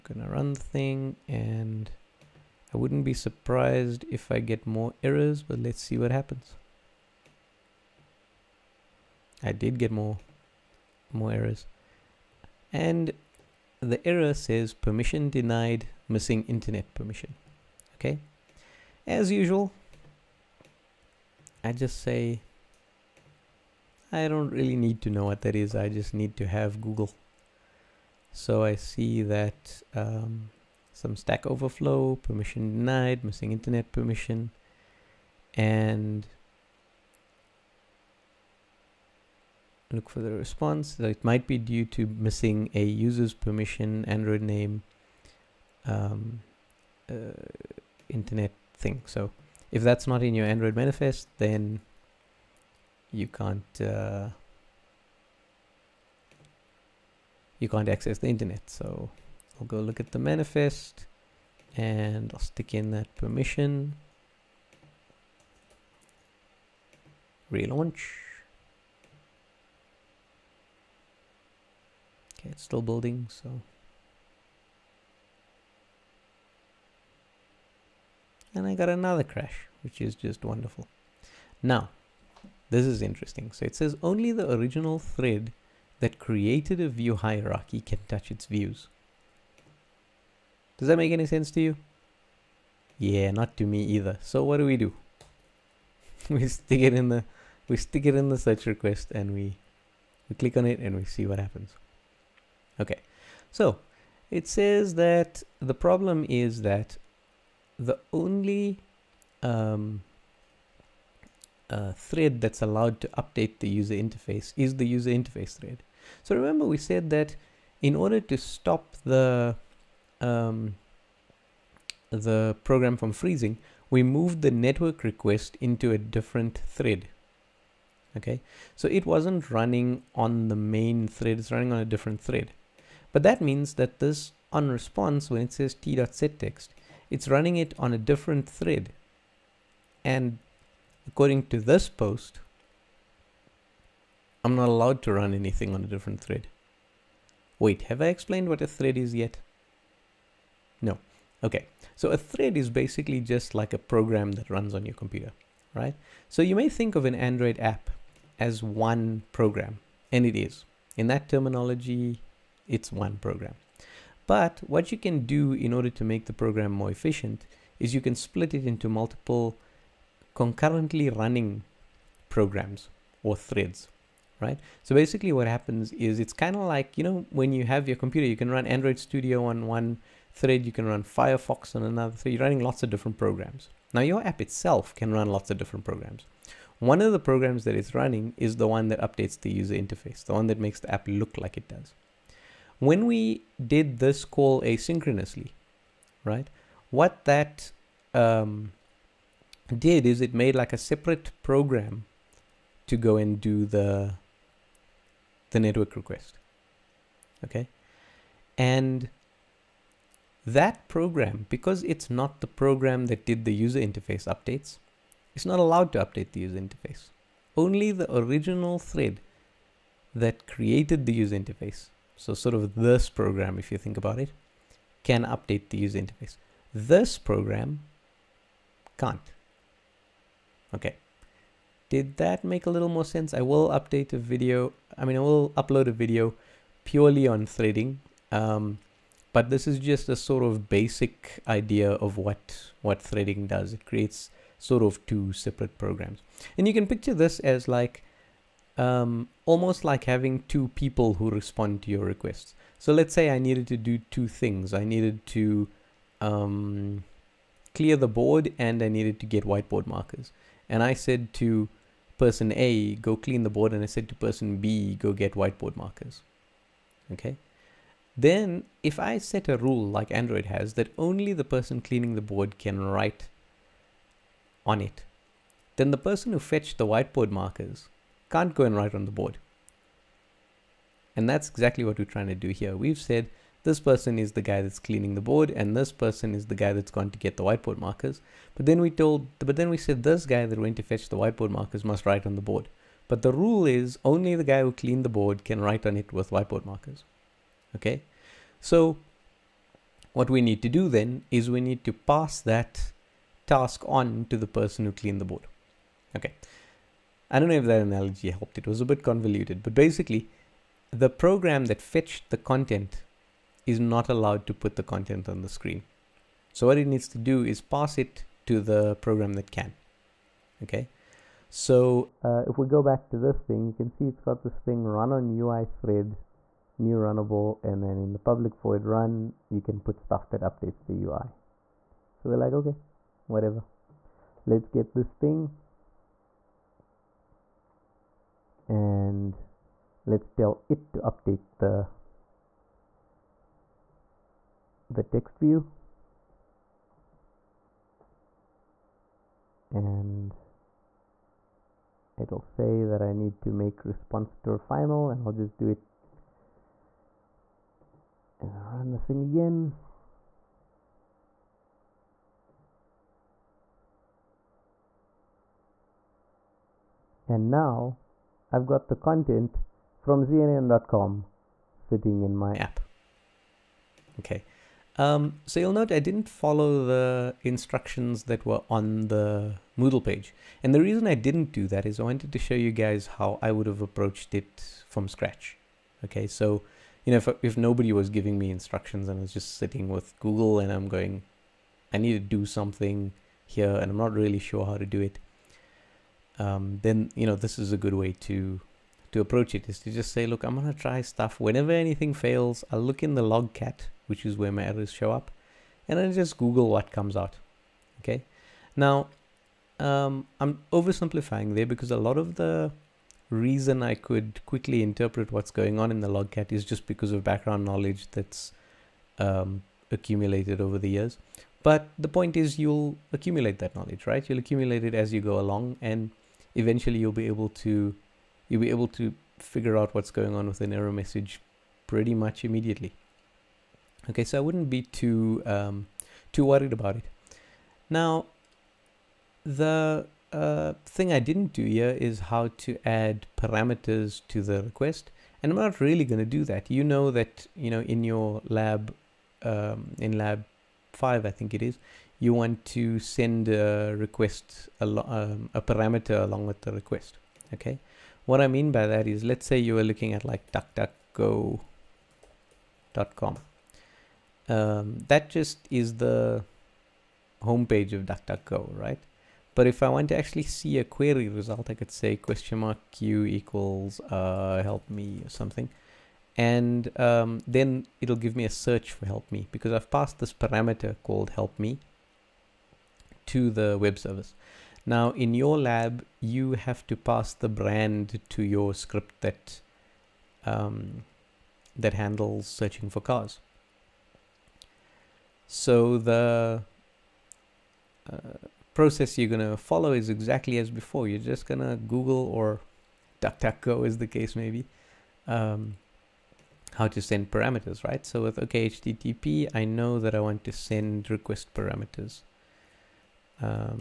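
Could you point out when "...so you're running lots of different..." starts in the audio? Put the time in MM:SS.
03:02.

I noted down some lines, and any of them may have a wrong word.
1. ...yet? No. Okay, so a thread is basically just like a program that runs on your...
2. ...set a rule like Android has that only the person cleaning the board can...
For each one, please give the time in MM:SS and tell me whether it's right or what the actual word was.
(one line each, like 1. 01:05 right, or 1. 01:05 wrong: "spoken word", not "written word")
1. 02:29 right
2. 04:29 right.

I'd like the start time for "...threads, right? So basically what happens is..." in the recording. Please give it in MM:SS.
02:53.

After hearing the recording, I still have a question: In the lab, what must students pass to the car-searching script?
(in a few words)
the brand.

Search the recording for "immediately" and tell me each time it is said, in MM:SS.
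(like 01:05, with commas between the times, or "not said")
07:12.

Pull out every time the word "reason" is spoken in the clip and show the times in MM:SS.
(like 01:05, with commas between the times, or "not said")
06:20, 06:53.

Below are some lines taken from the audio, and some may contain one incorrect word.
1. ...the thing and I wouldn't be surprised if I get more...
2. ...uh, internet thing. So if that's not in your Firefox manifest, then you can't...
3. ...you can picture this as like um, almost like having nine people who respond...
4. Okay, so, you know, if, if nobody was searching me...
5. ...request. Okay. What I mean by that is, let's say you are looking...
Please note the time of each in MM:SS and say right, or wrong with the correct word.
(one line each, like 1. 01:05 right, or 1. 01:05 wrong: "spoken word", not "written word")
1. 00:00 right
2. 00:47 wrong: "Android", not "Firefox"
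3. 04:06 wrong: "two", not "nine"
4. 06:26 wrong: "giving", not "searching"
5. 07:36 right.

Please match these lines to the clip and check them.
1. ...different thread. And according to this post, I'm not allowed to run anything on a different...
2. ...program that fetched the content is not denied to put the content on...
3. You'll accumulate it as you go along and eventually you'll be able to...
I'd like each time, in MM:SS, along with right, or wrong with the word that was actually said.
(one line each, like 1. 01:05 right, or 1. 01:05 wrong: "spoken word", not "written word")
1. 02:17 right
2. 05:11 wrong: "allowed", not "denied"
3. 07:04 right.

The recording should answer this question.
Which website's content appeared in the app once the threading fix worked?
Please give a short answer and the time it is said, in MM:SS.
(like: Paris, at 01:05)
CNN.com, at 06:10.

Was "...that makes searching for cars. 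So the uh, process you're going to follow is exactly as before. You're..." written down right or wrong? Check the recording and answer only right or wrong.
wrong.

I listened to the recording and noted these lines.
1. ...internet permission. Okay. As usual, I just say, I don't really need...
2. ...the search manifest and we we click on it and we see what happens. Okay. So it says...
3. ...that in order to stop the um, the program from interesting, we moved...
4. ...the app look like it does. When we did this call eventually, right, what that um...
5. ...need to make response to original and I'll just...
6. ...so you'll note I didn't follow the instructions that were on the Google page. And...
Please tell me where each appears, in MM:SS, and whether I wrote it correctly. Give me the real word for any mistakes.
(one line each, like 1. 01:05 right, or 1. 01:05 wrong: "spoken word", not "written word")
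1. 00:16 right
2. 01:38 wrong: "request", not "manifest"
3. 01:57 wrong: "freezing", not "interesting"
4. 03:10 wrong: "asynchronously", not "eventually"
5. 05:53 wrong: "final", not "original"
6. 06:15 wrong: "Moodle", not "Google".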